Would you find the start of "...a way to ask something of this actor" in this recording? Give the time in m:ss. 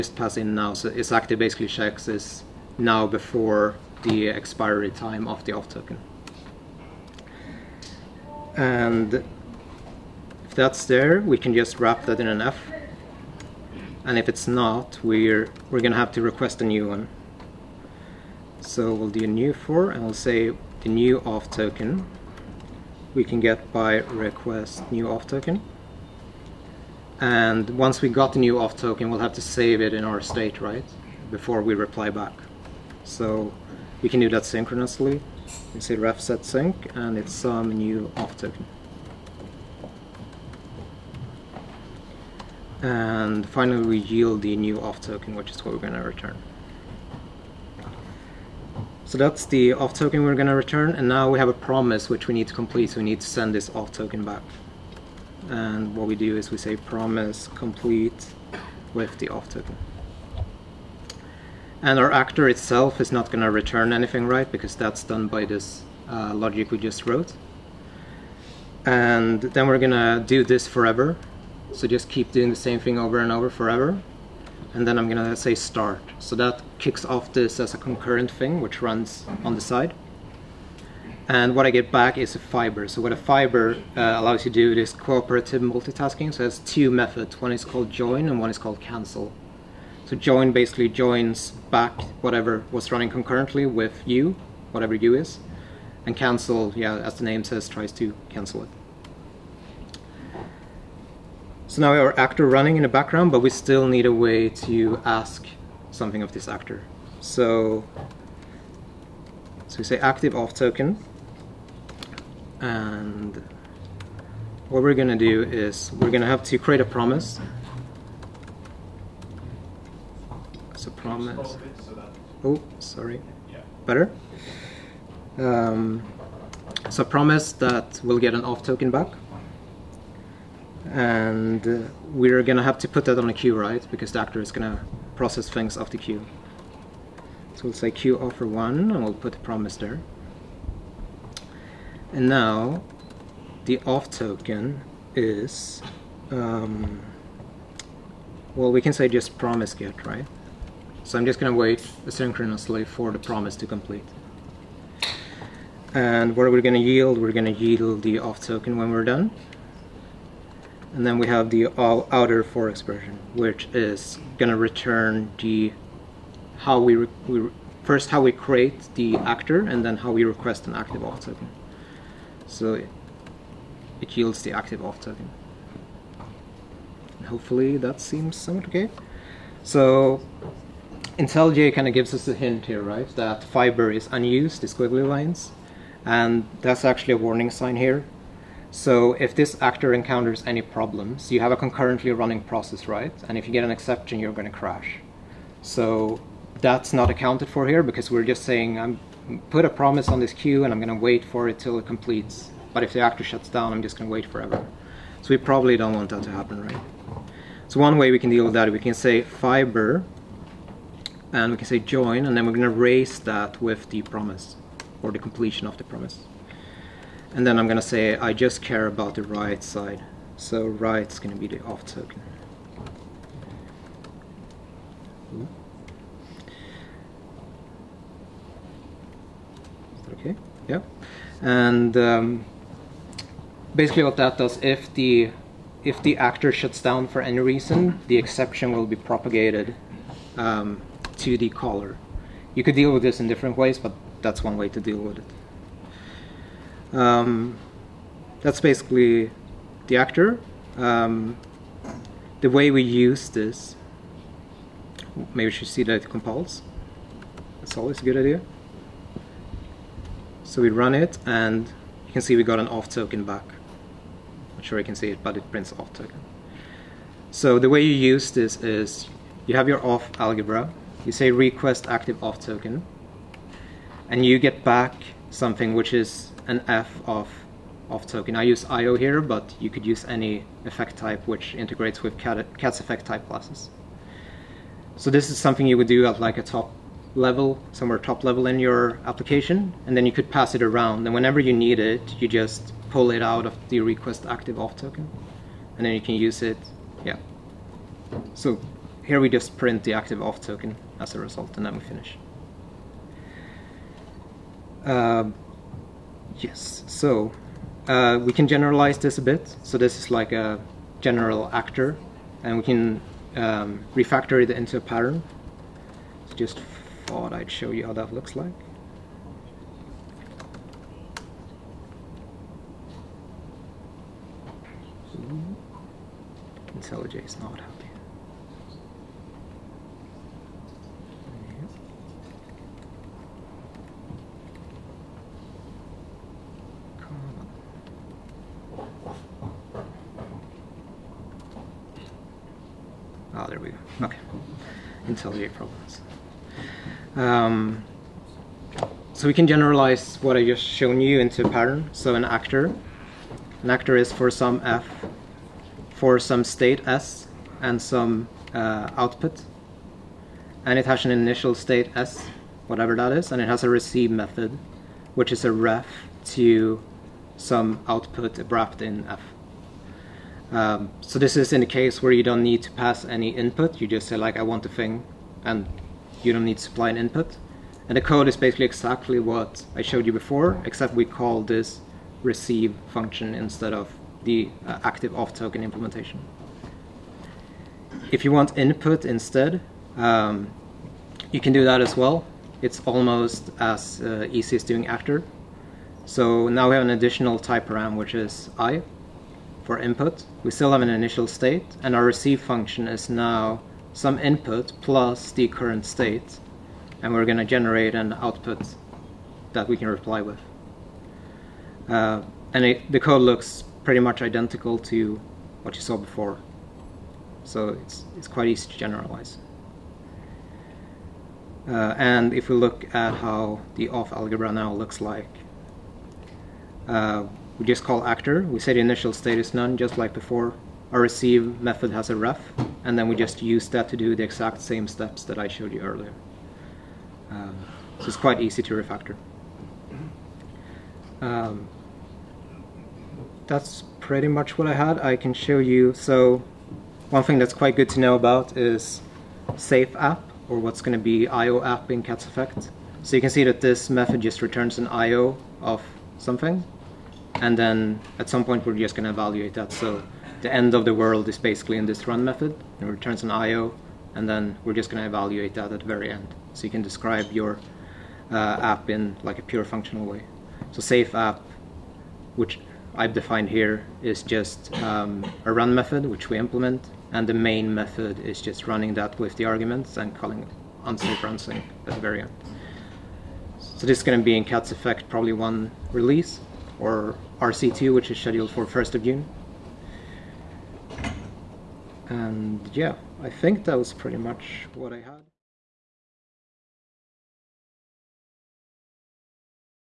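1:44.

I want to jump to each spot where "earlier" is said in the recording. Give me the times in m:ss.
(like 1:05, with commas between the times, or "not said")
7:15.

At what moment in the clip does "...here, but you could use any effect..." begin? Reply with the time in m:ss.
4:38.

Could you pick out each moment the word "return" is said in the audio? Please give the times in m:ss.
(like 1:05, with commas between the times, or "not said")
0:46, 0:50, 1:03, 2:44, 7:34, 7:42.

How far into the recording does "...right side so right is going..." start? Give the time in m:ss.
3:39.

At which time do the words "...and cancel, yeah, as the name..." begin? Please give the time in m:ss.
1:36.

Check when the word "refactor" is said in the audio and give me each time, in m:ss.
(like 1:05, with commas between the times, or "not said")
5:13, 7:18.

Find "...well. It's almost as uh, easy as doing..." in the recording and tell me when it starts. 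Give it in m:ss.
6:31.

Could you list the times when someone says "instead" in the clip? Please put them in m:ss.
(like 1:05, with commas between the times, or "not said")
6:23, 6:29.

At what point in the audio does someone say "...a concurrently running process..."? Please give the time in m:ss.
3:11.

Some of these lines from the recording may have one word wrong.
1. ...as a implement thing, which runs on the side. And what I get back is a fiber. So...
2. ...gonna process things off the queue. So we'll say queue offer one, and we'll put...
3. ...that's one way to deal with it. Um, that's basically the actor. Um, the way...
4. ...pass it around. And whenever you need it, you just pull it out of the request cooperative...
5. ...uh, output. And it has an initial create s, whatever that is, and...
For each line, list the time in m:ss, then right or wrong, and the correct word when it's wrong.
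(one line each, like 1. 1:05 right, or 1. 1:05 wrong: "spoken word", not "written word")
1. 1:17 wrong: "concurrent", not "implement"
2. 2:14 right
3. 4:04 right
4. 4:50 wrong: "active", not "cooperative"
5. 5:58 wrong: "state", not "create".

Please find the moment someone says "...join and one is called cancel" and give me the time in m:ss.
1:27.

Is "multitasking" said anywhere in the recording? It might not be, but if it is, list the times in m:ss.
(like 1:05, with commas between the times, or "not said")
1:25.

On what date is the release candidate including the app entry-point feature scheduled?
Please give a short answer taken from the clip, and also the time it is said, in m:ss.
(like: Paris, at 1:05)
1st of June, at 8:08.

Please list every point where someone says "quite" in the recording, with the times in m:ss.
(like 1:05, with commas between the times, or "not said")
6:58, 7:18, 7:27.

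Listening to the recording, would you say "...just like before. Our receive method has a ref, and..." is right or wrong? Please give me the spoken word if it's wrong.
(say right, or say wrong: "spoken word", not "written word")
right.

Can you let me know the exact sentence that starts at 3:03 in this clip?
That fiber is unused, these squiggly lines, and that's actually a warning sign here.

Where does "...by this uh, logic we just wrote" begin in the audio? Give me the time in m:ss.
1:05.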